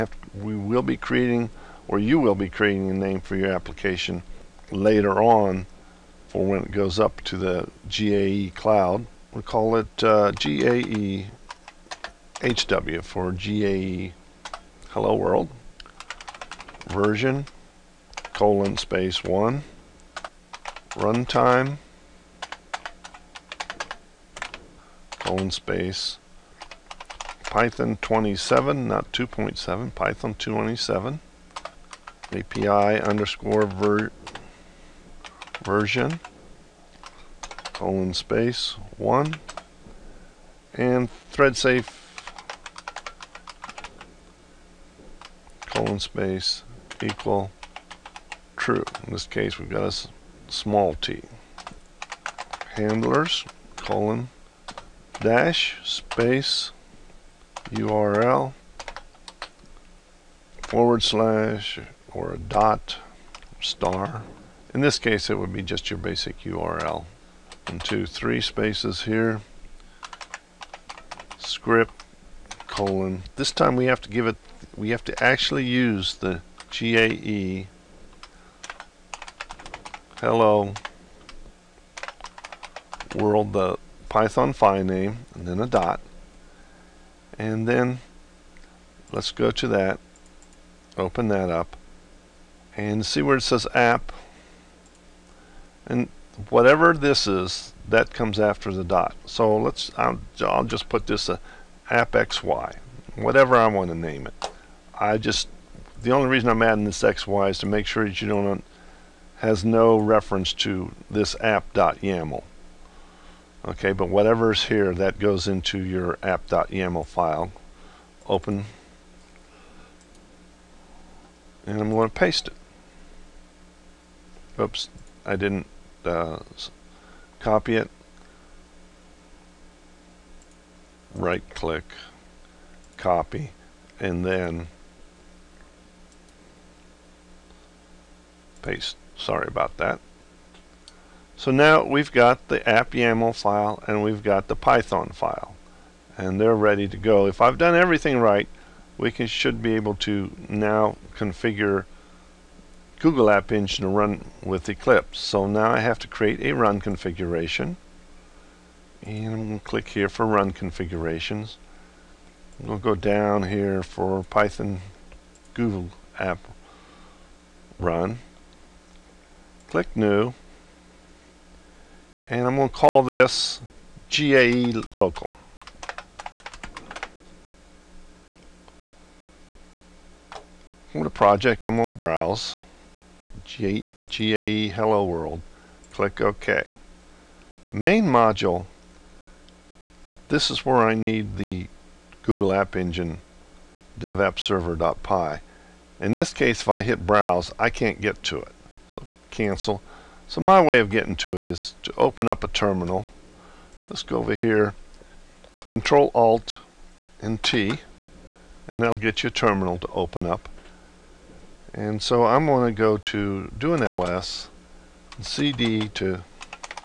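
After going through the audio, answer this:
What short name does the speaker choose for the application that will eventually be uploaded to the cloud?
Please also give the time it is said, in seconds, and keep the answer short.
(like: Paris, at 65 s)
GAE HW, at 10 s.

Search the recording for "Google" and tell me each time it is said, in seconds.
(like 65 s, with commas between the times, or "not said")
152 s, 165 s, 192 s.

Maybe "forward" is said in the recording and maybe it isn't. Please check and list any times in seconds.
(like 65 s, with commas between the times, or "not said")
60 s.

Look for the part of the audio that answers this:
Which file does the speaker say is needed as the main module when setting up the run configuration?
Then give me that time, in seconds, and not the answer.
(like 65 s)
193 s.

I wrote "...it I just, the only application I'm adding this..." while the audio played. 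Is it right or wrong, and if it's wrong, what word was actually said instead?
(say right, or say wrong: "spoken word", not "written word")
wrong: "reason", not "application".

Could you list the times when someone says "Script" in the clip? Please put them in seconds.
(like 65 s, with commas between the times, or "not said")
71 s.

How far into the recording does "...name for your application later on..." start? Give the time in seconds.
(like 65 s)
2 s.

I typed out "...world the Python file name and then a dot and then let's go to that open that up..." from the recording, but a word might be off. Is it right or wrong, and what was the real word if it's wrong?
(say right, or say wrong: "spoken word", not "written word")
right.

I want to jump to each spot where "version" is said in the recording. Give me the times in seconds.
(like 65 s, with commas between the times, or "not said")
16 s, 35 s.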